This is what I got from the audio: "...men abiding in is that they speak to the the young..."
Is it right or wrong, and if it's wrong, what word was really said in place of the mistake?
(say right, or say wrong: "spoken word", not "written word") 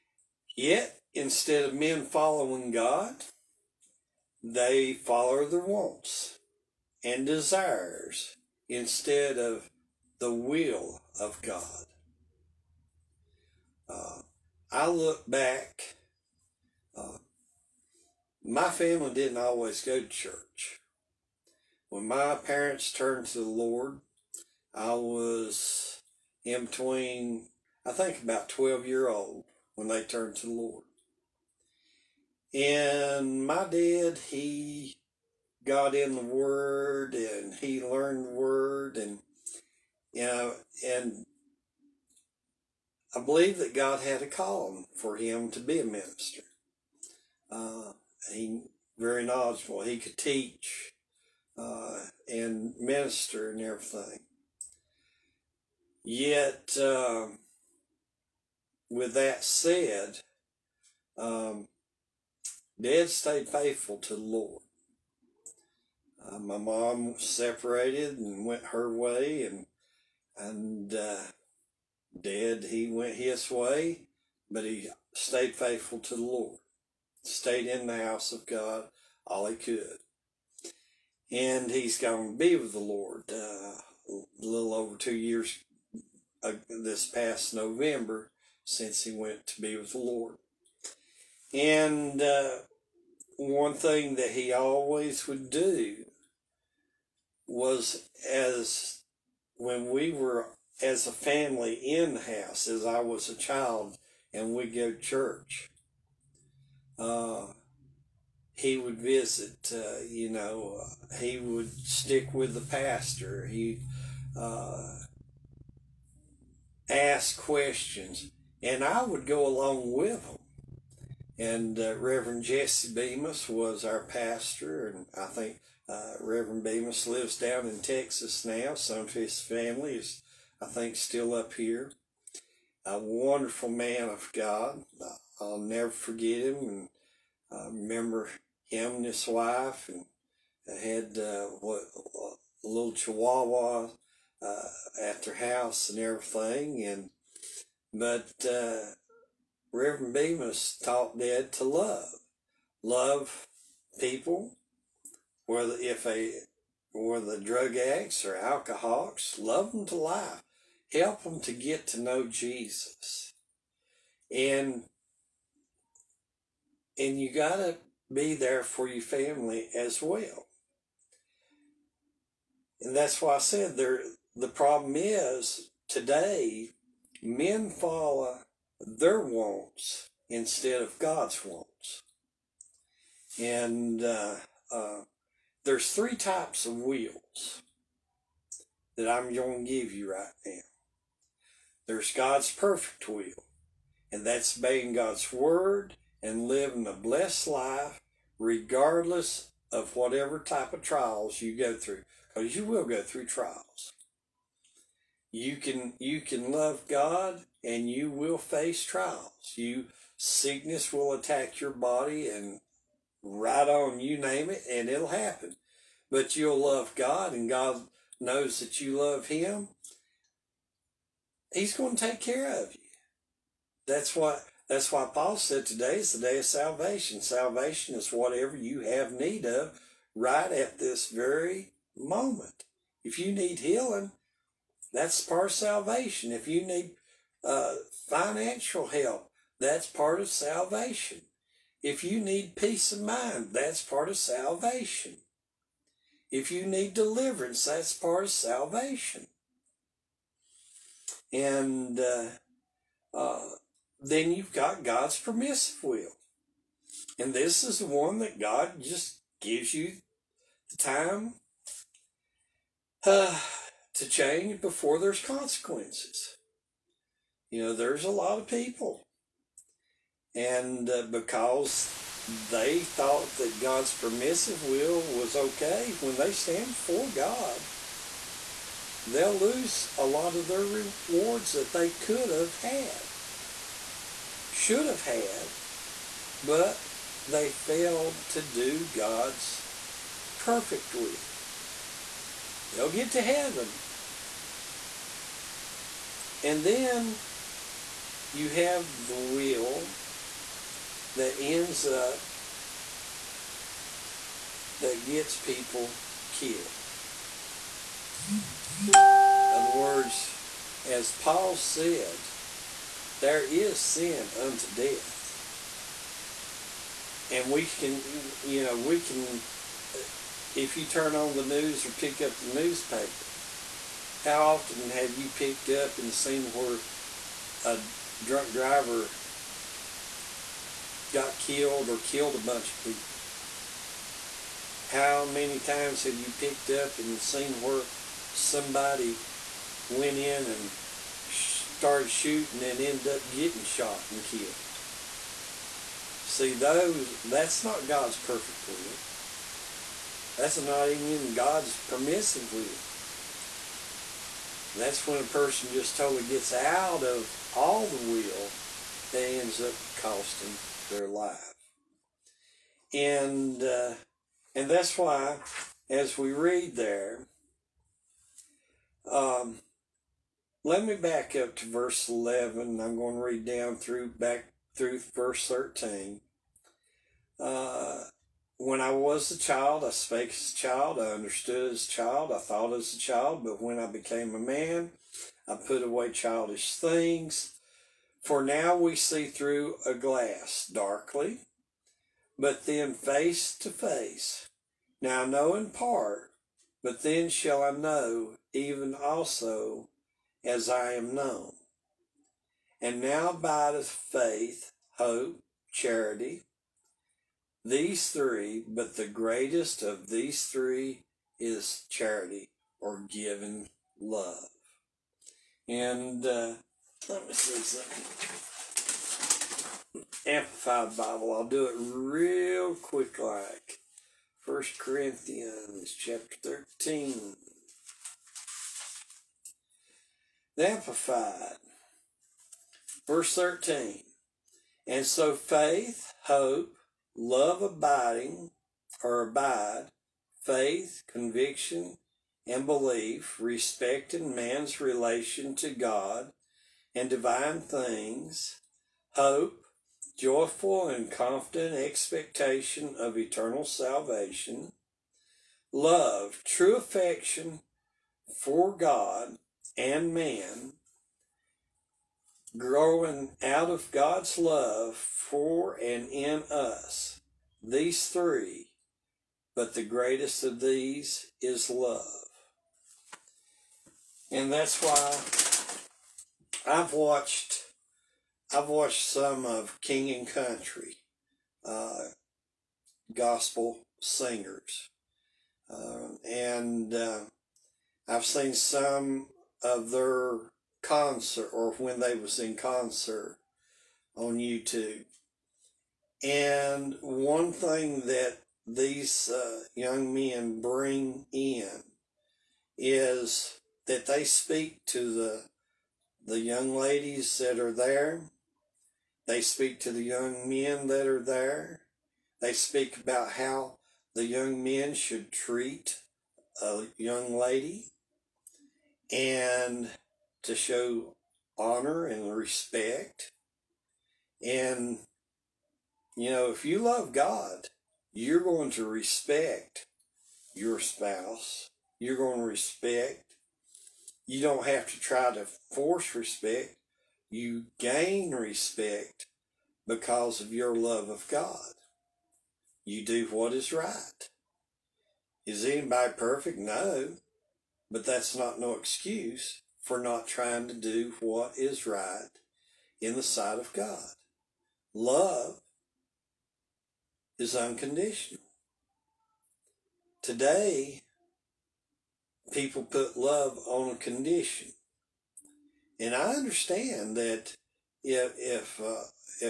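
wrong: "bring", not "abiding".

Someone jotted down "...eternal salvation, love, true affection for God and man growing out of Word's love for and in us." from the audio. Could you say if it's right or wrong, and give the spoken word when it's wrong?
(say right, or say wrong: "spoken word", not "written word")
wrong: "God", not "Word".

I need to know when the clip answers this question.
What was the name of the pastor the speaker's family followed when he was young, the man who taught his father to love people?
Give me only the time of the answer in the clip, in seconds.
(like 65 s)
122 s.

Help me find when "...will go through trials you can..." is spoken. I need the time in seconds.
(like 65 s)
202 s.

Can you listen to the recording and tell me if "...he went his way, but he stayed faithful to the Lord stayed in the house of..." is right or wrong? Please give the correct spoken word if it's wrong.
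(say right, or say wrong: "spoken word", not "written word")
right.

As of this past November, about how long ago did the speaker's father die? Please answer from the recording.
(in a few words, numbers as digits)
a little over 2 years.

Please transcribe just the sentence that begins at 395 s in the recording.
Now I know in part, but then shall I know even also as I am known.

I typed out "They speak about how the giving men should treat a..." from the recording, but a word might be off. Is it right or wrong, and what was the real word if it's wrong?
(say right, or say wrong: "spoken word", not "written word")
wrong: "young", not "giving".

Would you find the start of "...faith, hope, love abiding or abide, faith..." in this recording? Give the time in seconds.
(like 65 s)
435 s.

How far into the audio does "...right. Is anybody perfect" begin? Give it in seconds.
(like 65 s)
543 s.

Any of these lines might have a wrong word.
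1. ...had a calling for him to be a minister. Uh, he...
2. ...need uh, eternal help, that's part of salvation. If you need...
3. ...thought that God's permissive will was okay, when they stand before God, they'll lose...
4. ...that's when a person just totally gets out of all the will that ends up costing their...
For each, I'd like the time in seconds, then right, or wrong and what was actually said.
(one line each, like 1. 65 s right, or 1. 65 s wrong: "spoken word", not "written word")
1. 44 s right
2. 236 s wrong: "financial", not "eternal"
3. 272 s right
4. 354 s right.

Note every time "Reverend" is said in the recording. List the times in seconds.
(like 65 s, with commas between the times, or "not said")
121 s, 126 s, 149 s.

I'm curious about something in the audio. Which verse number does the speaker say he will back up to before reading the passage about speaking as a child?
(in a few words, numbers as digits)
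11.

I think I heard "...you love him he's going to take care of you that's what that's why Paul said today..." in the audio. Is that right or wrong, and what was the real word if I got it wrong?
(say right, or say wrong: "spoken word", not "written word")
right.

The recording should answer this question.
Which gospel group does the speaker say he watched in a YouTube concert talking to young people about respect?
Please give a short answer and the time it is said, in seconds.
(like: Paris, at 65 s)
King and Country, at 479 s.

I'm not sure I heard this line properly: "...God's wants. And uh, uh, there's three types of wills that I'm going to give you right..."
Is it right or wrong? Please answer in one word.
right.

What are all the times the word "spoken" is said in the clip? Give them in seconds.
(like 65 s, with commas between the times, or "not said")
not said.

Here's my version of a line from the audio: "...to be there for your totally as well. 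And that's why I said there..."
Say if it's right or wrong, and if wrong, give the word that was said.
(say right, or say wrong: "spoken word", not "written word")
wrong: "family", not "totally".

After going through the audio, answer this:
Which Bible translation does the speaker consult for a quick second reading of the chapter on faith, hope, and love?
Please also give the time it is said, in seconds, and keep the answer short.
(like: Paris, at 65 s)
Amplified Bible, at 420 s.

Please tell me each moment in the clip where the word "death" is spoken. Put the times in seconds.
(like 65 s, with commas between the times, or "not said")
314 s.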